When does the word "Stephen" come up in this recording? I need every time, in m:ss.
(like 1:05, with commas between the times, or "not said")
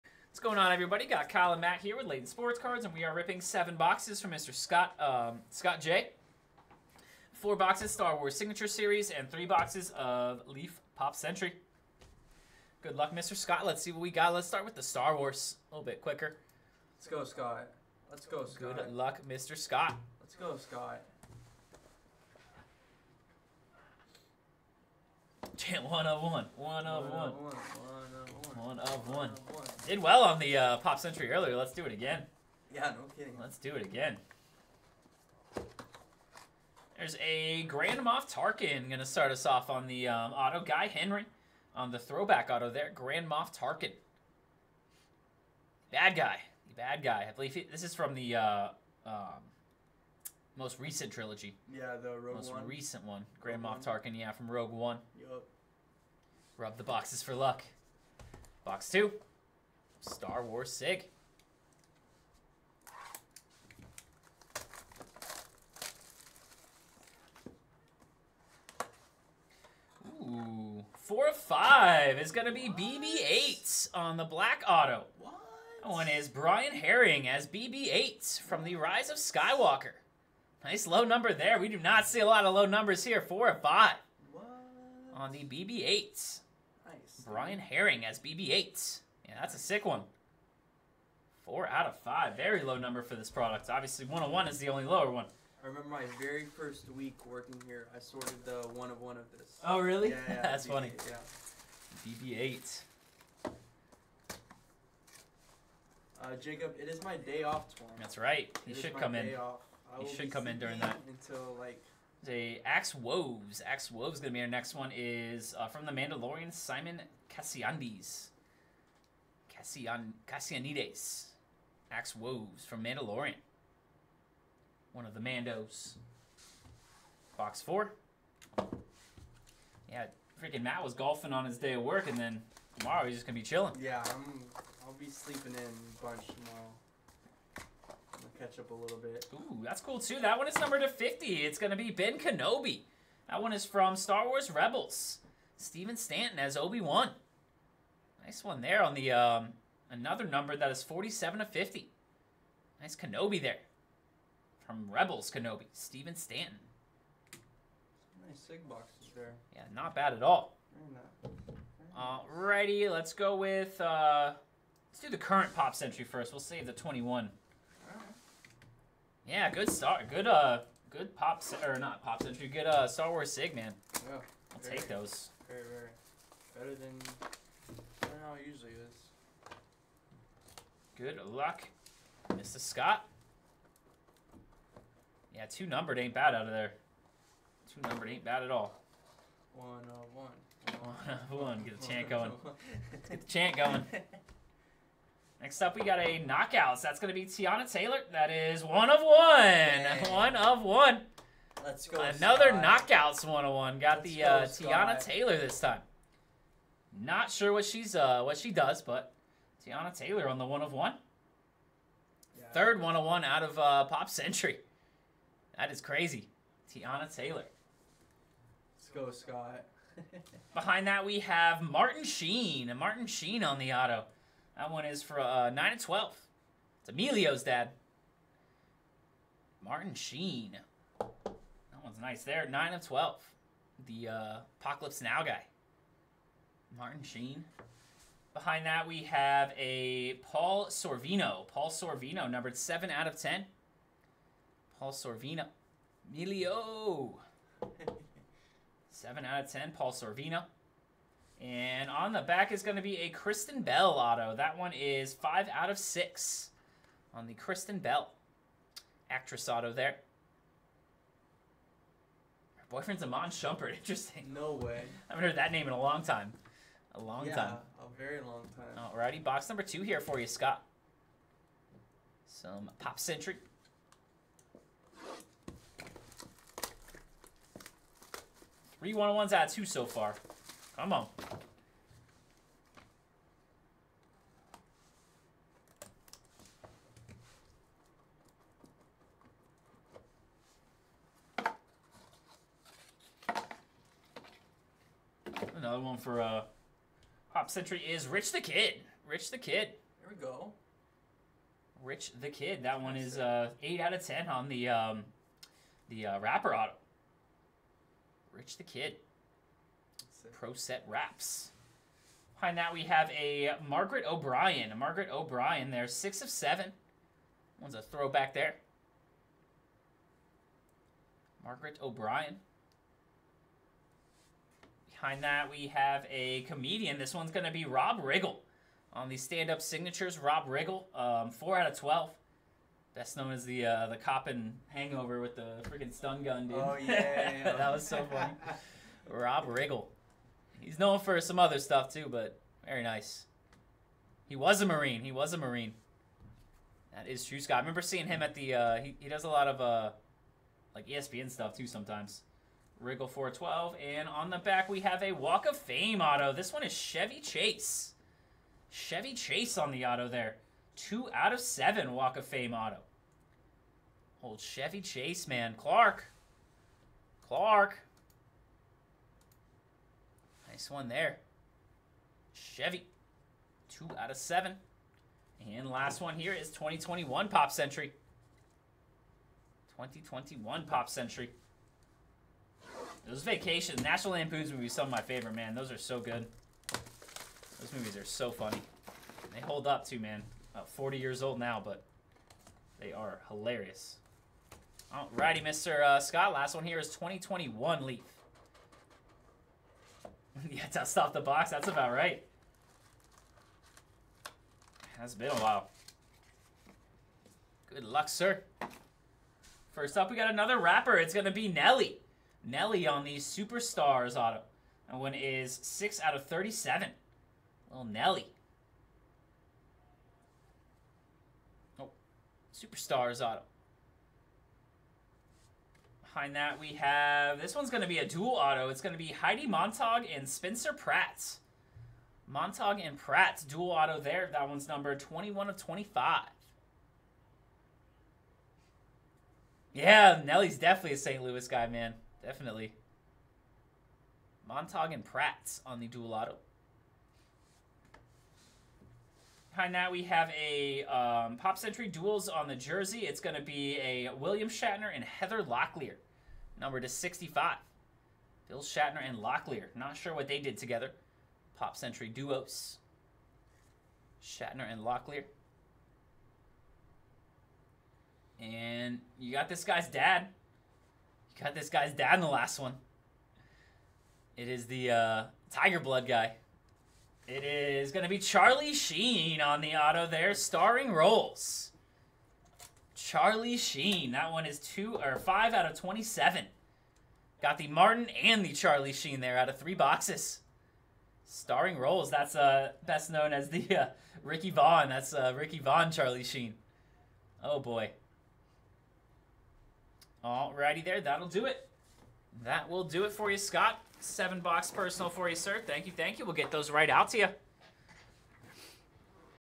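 2:25, 2:35.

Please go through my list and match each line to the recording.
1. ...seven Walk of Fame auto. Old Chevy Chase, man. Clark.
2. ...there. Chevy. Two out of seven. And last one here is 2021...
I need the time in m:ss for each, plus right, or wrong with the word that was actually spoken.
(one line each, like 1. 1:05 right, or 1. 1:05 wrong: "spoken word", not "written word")
1. 6:01 right
2. 6:10 right.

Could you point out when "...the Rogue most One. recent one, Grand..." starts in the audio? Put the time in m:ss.
0:52.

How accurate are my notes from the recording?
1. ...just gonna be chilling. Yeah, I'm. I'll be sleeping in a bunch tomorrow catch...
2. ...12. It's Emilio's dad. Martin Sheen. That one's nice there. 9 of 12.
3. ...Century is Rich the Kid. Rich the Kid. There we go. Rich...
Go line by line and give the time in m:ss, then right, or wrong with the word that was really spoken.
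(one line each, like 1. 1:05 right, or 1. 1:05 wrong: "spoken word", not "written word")
1. 2:13 right
2. 3:45 right
3. 4:57 right.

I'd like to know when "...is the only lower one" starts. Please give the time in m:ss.
1:34.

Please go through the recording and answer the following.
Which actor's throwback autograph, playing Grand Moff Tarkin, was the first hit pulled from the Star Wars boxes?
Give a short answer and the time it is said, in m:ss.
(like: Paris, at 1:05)
Guy Henry, at 0:40.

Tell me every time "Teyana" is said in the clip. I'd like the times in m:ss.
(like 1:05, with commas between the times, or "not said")
3:17, 3:24, 3:29, 3:36.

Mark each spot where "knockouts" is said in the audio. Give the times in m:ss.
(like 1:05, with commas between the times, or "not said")
3:16, 3:22.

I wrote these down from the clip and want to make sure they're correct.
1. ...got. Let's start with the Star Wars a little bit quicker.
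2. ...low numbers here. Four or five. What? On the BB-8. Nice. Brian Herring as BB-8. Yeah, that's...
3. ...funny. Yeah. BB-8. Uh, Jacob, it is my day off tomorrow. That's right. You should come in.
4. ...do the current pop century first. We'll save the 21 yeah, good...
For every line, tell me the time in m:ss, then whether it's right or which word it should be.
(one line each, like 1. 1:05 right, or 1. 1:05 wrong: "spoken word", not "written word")
1. 0:14 right
2. 1:22 right
3. 1:40 right
4. 2:44 right.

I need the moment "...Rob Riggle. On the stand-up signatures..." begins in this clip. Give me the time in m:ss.
5:27.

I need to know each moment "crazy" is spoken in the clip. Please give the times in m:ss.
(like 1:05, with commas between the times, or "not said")
3:35.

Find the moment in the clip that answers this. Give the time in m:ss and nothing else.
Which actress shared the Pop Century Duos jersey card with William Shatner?
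7:35.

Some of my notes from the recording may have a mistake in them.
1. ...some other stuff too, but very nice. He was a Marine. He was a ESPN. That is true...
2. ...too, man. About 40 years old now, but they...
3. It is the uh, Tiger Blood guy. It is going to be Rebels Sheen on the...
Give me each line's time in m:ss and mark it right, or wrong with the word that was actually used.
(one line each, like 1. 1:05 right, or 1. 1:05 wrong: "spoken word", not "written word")
1. 5:41 wrong: "Marine", not "ESPN"
2. 6:29 right
3. 7:54 wrong: "Charlie", not "Rebels".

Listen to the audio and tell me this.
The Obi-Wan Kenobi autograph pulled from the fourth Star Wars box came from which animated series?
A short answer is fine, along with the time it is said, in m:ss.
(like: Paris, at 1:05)
Star Wars Rebels, at 2:23.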